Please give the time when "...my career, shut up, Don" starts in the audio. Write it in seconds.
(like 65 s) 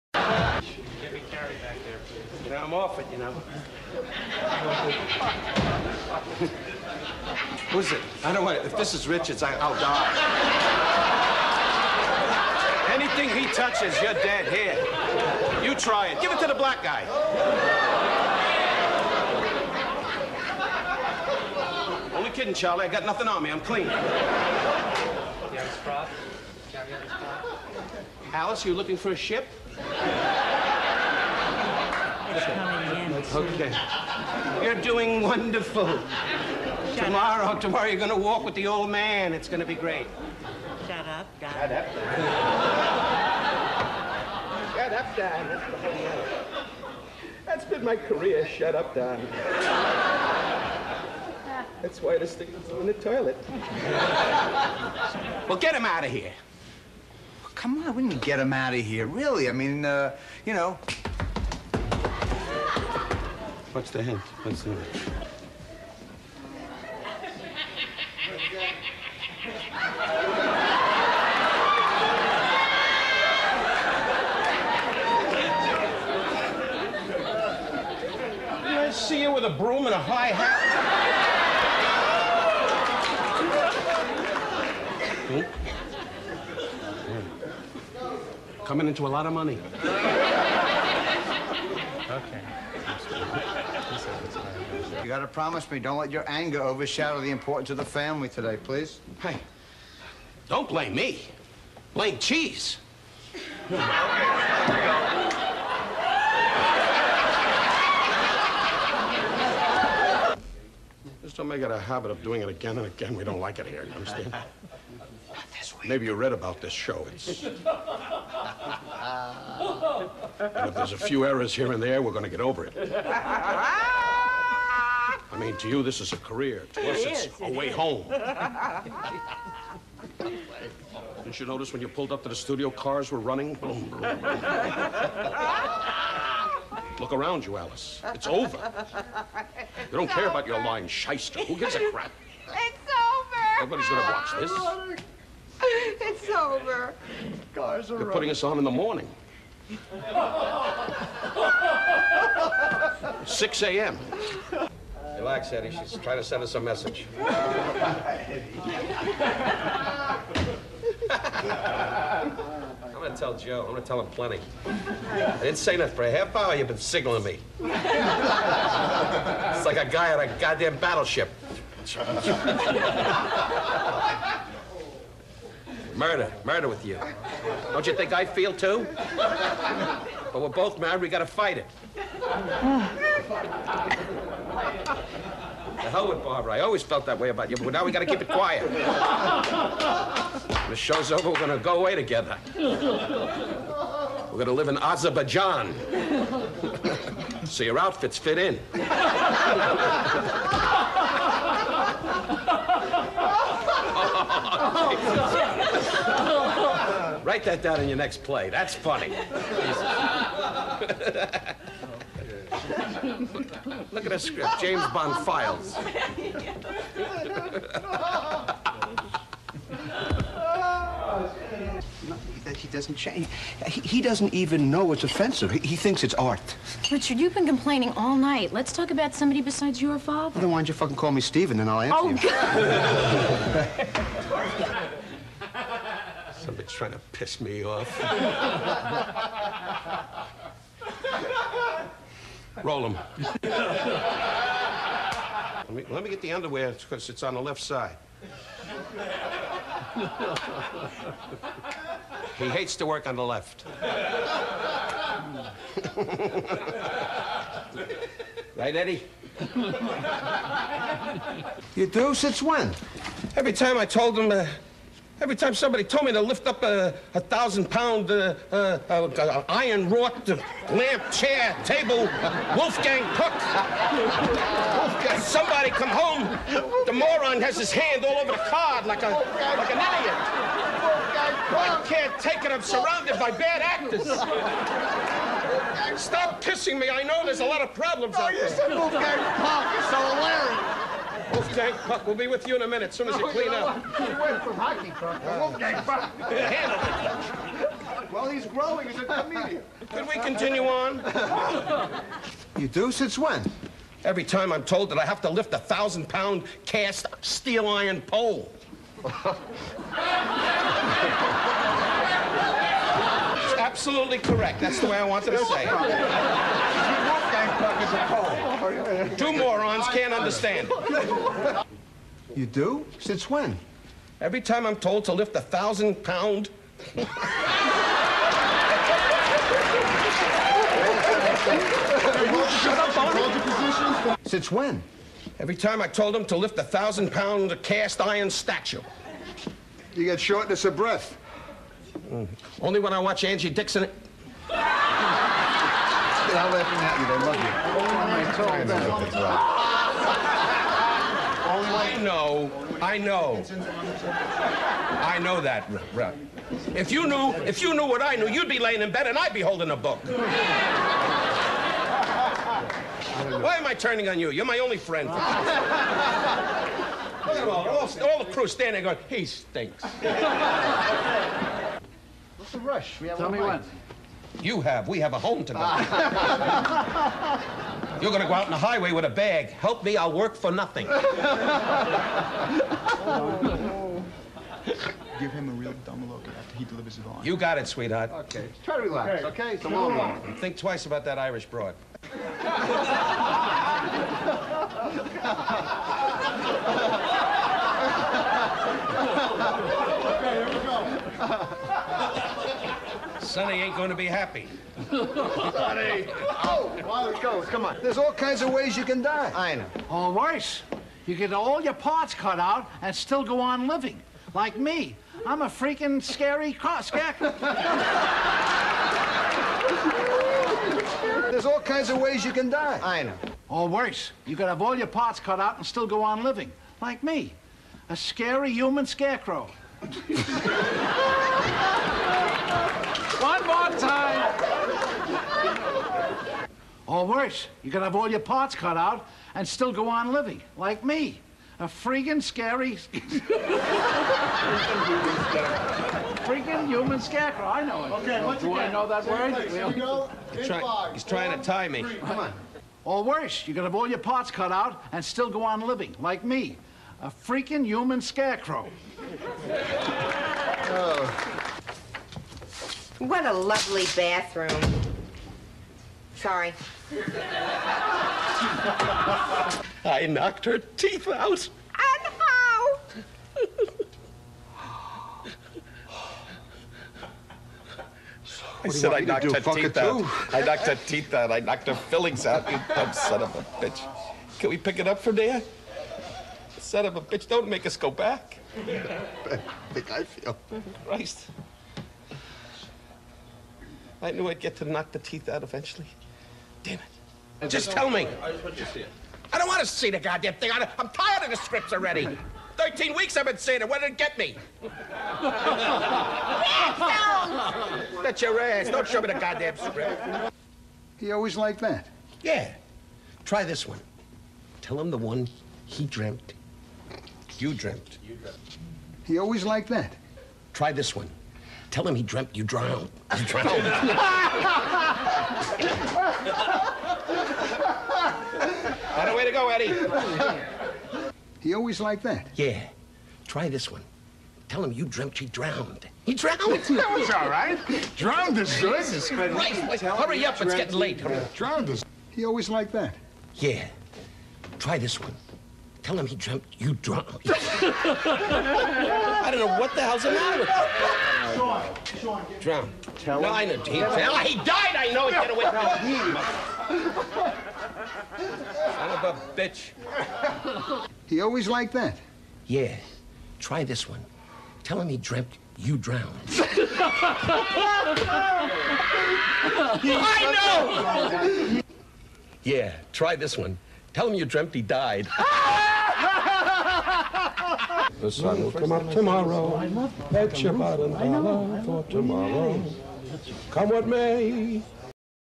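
47 s.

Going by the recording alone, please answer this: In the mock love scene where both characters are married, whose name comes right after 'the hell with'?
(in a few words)
Barbara.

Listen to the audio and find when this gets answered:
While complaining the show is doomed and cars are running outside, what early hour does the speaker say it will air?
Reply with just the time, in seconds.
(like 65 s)
153 s.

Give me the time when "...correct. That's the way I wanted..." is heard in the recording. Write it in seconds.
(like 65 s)
314 s.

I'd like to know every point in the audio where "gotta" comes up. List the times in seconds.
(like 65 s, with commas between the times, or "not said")
95 s, 181 s, 187 s.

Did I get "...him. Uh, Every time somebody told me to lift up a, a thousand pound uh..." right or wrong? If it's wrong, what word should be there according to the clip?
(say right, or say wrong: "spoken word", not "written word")
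right.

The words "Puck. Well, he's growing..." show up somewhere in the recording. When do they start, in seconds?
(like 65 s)
296 s.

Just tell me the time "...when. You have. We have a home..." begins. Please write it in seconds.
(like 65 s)
373 s.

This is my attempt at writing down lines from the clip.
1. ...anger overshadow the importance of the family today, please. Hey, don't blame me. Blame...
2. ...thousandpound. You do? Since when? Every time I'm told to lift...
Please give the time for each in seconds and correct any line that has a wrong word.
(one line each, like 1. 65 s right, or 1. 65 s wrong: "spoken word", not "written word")
1. 96 s right
2. 320 s wrong: "understand", not "thousandpound".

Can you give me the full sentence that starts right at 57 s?
come on, we can get him out of here, really.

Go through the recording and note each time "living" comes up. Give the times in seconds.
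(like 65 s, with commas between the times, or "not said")
413 s, 426 s, 440 s, 455 s.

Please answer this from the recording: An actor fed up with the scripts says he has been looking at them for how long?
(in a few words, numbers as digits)
13 weeks.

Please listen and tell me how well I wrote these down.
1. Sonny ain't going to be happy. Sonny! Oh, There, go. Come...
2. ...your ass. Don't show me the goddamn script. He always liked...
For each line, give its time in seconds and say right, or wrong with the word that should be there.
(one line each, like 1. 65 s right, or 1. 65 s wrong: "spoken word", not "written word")
1. 403 s wrong: "Wilder", not "There"
2. 508 s right.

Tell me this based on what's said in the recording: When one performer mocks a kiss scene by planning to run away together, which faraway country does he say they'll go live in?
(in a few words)
Azerbaijan.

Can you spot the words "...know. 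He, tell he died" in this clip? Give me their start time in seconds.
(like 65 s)
553 s.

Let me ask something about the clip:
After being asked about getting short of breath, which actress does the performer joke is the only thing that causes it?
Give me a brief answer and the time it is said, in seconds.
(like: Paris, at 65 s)
Angie Dickinson, at 343 s.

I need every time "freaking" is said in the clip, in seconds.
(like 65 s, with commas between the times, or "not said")
415 s, 441 s, 446 s, 457 s.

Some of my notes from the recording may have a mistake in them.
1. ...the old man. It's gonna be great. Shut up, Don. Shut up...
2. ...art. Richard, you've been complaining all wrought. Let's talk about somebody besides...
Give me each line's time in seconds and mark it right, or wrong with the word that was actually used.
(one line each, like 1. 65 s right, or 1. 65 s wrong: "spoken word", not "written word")
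1. 38 s wrong: "Dad", not "Don"
2. 226 s wrong: "night", not "wrought".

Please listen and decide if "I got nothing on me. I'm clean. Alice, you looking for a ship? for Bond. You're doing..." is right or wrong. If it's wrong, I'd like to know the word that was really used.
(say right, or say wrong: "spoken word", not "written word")
wrong: "Okay", not "Bond".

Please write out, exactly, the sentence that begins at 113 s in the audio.
We don't like it here, you understand?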